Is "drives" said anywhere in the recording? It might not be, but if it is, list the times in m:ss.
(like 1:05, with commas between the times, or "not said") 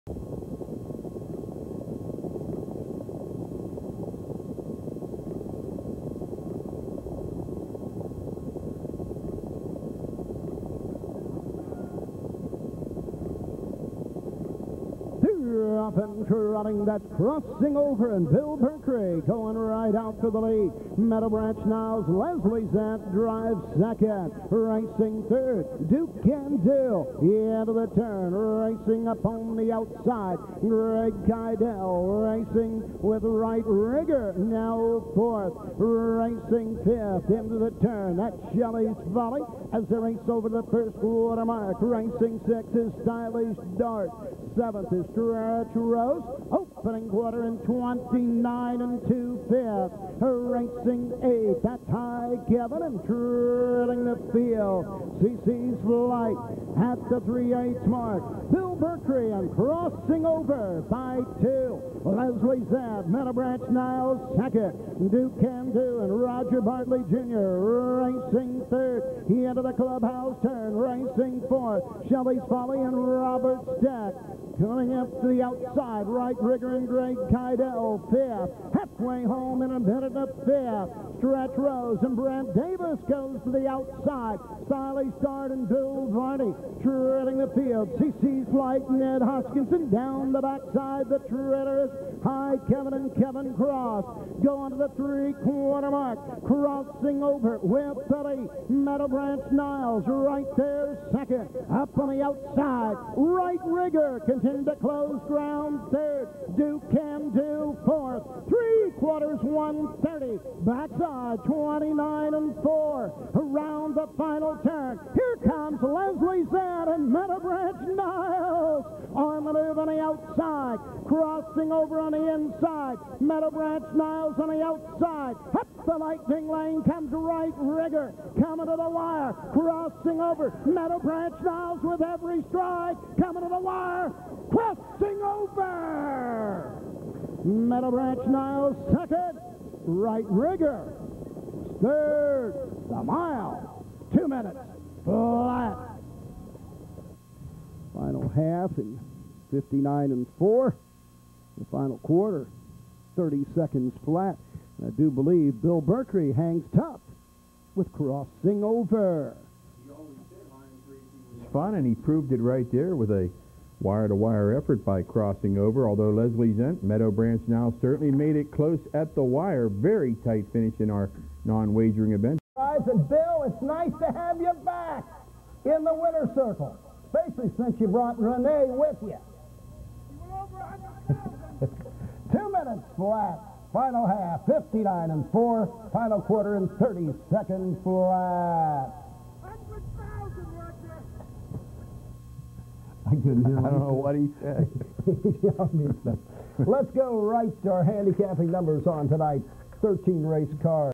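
0:23.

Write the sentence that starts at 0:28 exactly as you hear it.
Racing up on the outside, Greg Kydell racing with right rigor.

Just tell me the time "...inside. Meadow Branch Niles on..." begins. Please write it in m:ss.
2:02.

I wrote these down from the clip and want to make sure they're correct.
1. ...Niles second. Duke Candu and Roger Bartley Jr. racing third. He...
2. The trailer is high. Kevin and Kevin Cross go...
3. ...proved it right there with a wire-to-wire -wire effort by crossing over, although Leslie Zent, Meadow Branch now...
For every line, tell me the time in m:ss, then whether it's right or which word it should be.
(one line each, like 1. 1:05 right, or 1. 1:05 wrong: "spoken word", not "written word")
1. 1:03 right
2. 1:31 right
3. 2:41 right.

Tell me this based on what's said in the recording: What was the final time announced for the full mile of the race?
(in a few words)
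2 minutes flat.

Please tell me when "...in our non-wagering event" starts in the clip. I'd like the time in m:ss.
2:50.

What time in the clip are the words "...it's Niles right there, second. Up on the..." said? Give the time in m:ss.
1:39.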